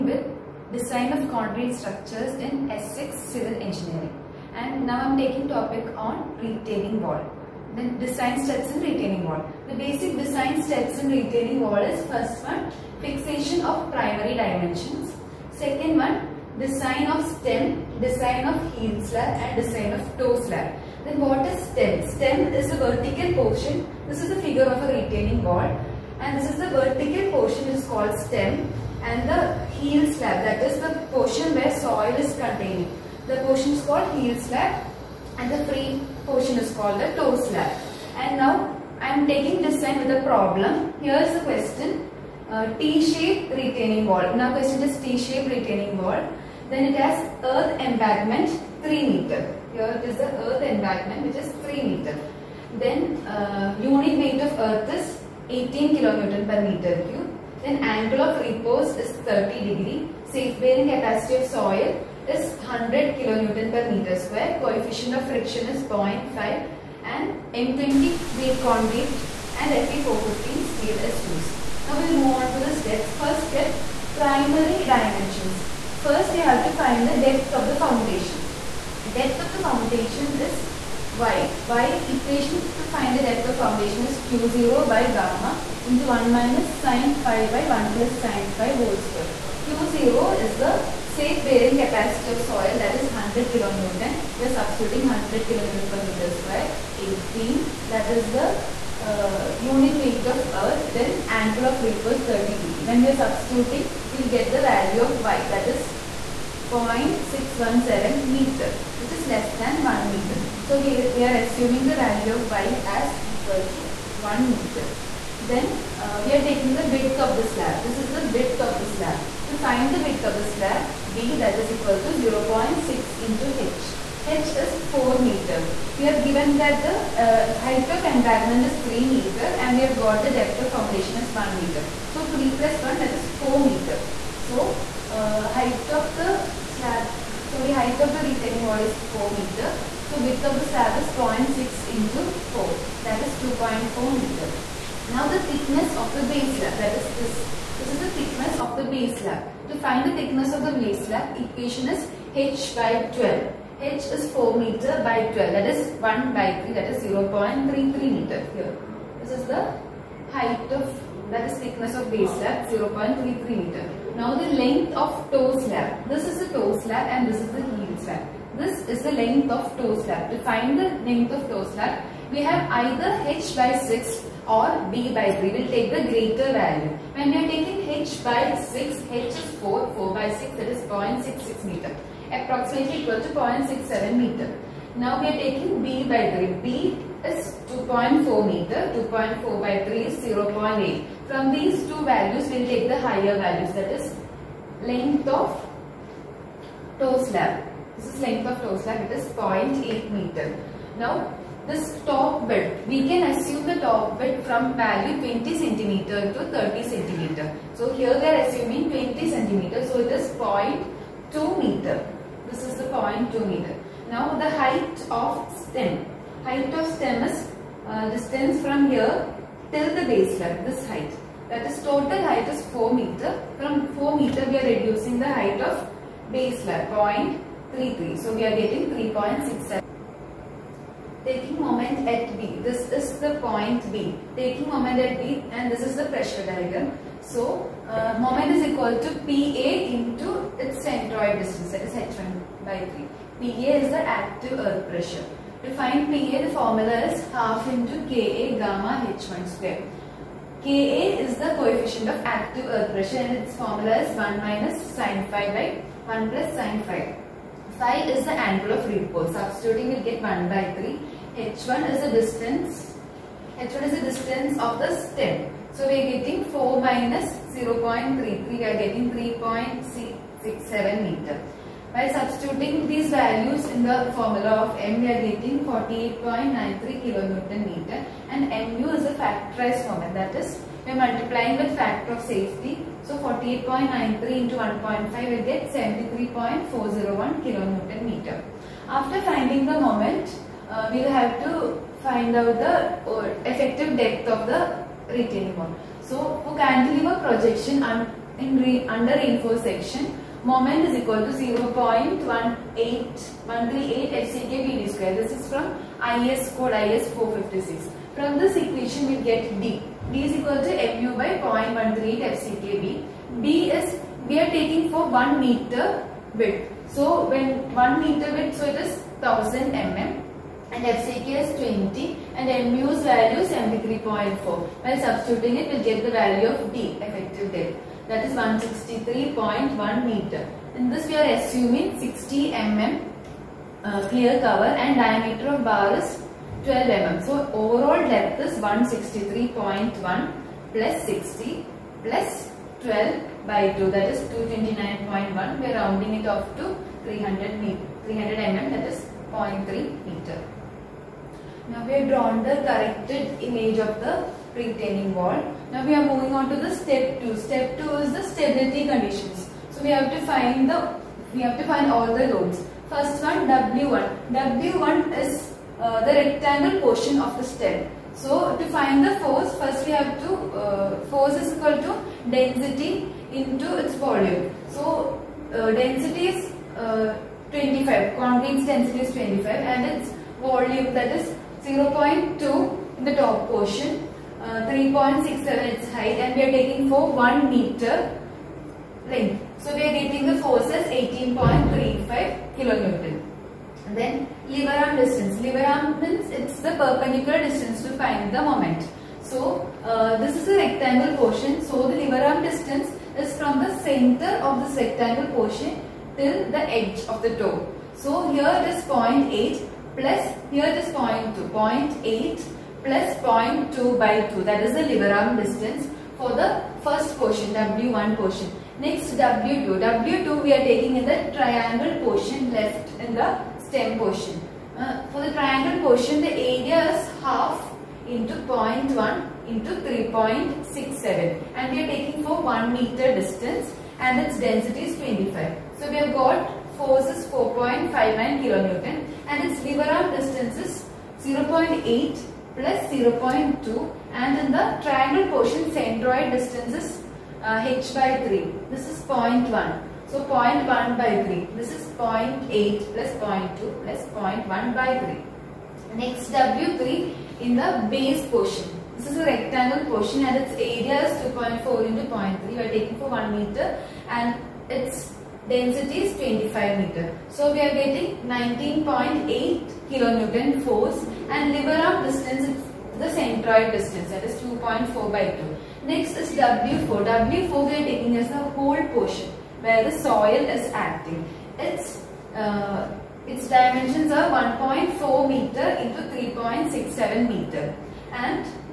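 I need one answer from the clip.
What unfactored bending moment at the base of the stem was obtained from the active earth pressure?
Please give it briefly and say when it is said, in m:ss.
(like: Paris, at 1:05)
48.93 kNm, at 4:35.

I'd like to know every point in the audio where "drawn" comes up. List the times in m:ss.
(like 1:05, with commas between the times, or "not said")
5:52.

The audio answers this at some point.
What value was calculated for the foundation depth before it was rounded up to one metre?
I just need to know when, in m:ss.
1:46.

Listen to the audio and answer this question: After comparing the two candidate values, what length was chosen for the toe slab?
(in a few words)
0.8 m.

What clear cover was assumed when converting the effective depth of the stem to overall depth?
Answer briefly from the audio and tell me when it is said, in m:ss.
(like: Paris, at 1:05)
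60 mm, at 5:31.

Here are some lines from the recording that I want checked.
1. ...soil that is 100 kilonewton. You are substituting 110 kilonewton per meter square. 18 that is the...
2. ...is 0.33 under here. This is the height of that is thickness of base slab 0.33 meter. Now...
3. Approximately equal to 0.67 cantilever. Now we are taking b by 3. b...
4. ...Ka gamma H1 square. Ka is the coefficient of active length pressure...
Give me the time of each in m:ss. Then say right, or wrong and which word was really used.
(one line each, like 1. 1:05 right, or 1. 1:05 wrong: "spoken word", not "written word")
1. 1:32 wrong: "100", not "110"
2. 2:36 wrong: "meter", not "under"
3. 3:02 wrong: "meter", not "cantilever"
4. 4:08 wrong: "earth", not "length".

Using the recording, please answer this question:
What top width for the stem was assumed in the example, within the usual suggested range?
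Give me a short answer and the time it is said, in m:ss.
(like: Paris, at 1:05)
20 cm, at 3:28.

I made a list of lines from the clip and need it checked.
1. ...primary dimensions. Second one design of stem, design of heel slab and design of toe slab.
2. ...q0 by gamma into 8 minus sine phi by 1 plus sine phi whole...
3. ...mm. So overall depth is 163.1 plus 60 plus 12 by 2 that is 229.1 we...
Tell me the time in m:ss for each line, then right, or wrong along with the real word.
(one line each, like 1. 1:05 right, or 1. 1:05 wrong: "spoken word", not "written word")
1. 0:13 right
2. 1:24 wrong: "1", not "8"
3. 5:36 right.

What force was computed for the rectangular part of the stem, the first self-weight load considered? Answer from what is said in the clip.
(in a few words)
18.35 kN.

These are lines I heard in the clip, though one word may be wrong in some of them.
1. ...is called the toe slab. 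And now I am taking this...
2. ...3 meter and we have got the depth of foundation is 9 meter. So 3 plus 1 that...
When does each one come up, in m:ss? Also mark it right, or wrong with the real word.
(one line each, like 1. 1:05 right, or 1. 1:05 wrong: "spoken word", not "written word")
1. 0:36 right
2. 2:08 wrong: "1", not "9".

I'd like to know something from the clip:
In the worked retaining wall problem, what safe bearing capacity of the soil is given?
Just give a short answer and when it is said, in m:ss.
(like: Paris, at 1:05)
100 kN/m², at 1:00.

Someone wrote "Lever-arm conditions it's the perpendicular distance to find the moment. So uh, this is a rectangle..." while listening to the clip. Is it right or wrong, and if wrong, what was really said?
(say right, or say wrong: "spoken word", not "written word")
wrong: "means", not "conditions".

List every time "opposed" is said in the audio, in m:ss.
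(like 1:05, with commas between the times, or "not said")
not said.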